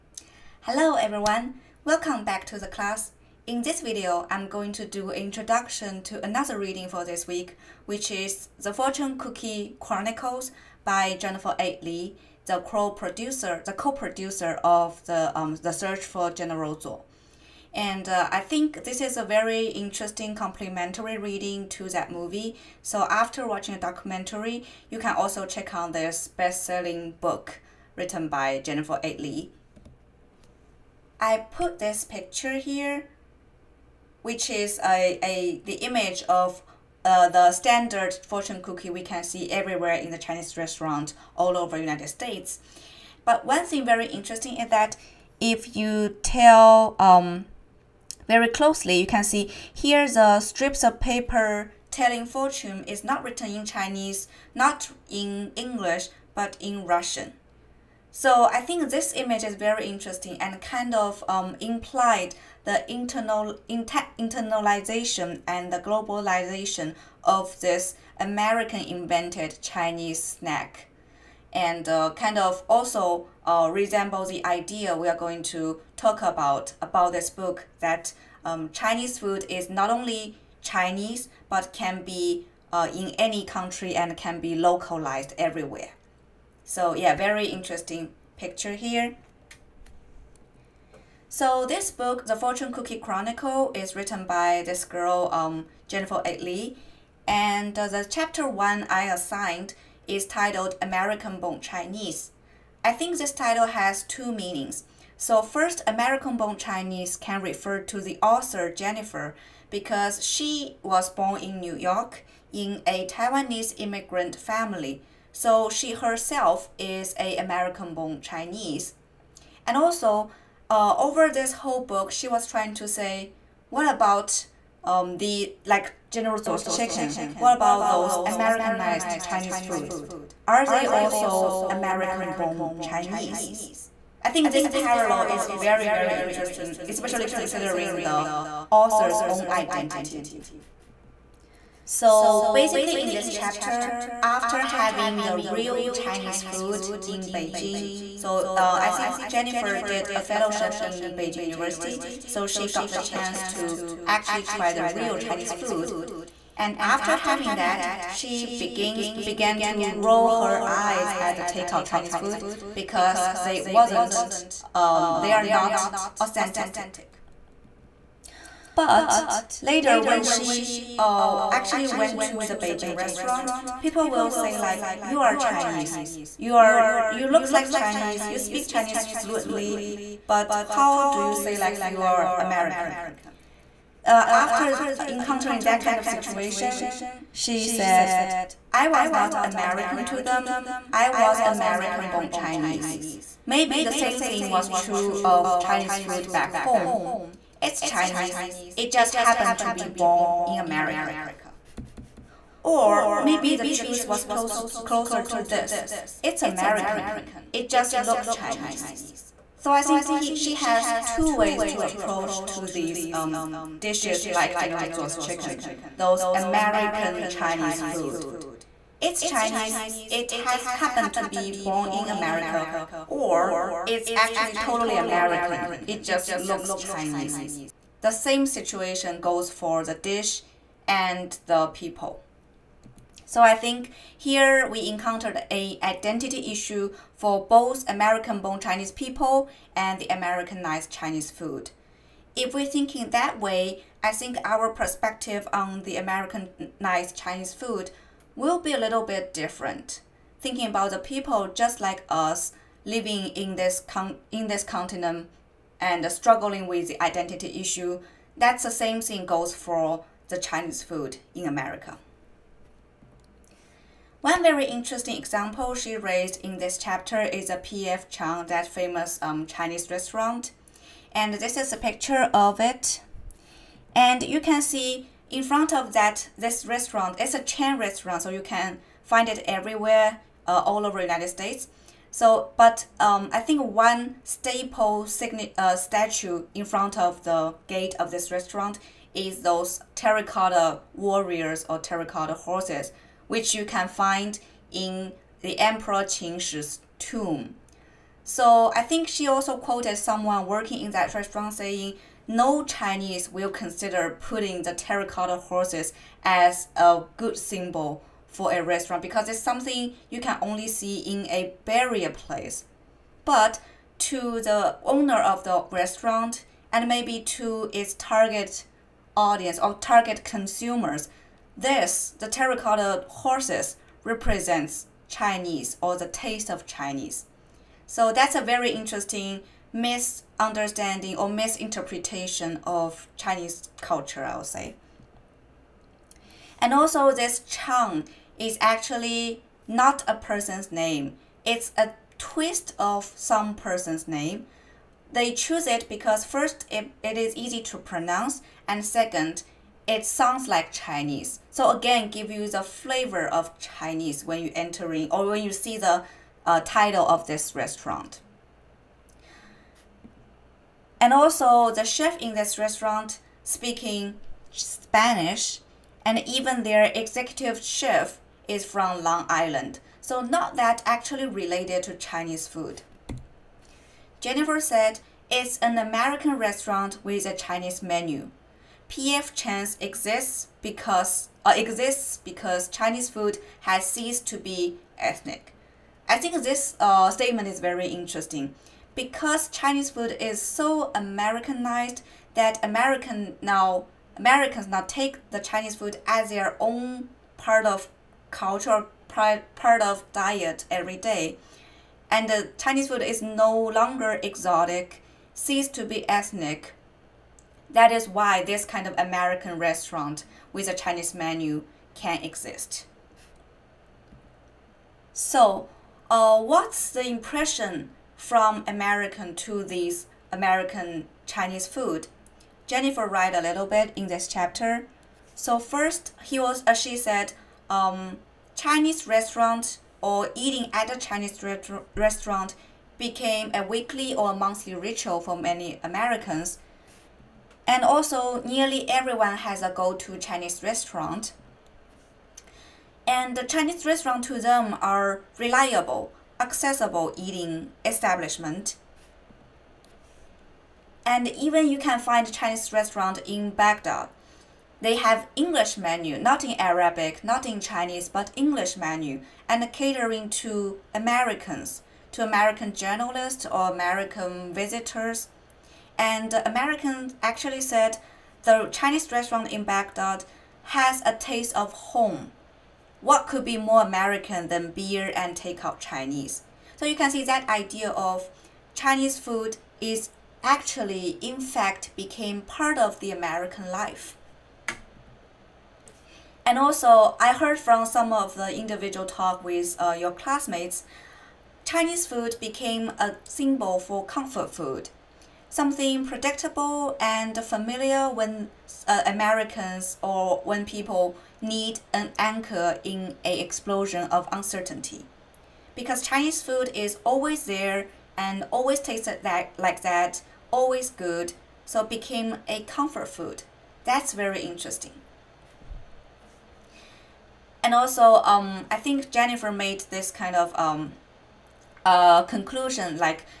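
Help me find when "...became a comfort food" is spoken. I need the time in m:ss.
8:31.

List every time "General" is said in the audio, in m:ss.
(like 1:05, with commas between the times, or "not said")
0:16, 2:06, 3:34.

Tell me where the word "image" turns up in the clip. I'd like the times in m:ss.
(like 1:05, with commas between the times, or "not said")
0:35, 0:59.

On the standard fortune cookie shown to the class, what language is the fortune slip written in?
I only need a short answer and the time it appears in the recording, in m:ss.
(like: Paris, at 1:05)
Russian, at 0:56.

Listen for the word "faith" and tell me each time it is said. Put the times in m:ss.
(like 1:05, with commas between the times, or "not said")
not said.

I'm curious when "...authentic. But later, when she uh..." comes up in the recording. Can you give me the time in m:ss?
2:46.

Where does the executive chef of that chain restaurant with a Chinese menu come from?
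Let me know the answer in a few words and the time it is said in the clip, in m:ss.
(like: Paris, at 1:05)
Long Island, at 6:09.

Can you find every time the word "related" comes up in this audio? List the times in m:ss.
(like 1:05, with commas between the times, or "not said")
6:11.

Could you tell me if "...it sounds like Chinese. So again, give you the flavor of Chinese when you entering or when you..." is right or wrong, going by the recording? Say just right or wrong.
right.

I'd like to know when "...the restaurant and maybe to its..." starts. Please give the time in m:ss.
5:15.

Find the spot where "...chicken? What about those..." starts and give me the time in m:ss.
2:06.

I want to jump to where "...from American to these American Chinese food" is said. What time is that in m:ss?
6:58.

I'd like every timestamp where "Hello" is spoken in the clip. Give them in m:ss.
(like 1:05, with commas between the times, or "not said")
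0:00.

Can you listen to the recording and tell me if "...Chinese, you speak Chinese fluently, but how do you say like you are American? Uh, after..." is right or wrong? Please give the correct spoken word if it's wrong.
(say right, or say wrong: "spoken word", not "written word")
right.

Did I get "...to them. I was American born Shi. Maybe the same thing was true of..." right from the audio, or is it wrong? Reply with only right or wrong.
wrong.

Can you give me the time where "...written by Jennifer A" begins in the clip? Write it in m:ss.
0:27.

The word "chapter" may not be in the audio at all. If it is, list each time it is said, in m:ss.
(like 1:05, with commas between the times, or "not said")
1:38, 2:23, 4:26, 7:04.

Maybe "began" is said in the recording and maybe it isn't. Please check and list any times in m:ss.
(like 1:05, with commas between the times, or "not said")
2:39.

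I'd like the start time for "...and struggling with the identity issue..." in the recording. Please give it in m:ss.
4:15.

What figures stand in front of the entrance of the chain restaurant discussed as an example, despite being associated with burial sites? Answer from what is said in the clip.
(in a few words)
Terracotta warriors.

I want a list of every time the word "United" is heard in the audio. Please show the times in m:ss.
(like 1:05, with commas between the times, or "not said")
0:41, 4:41.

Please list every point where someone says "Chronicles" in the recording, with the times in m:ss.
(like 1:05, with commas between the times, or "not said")
0:09, 1:32.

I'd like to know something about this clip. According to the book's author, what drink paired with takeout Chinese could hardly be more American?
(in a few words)
Beer.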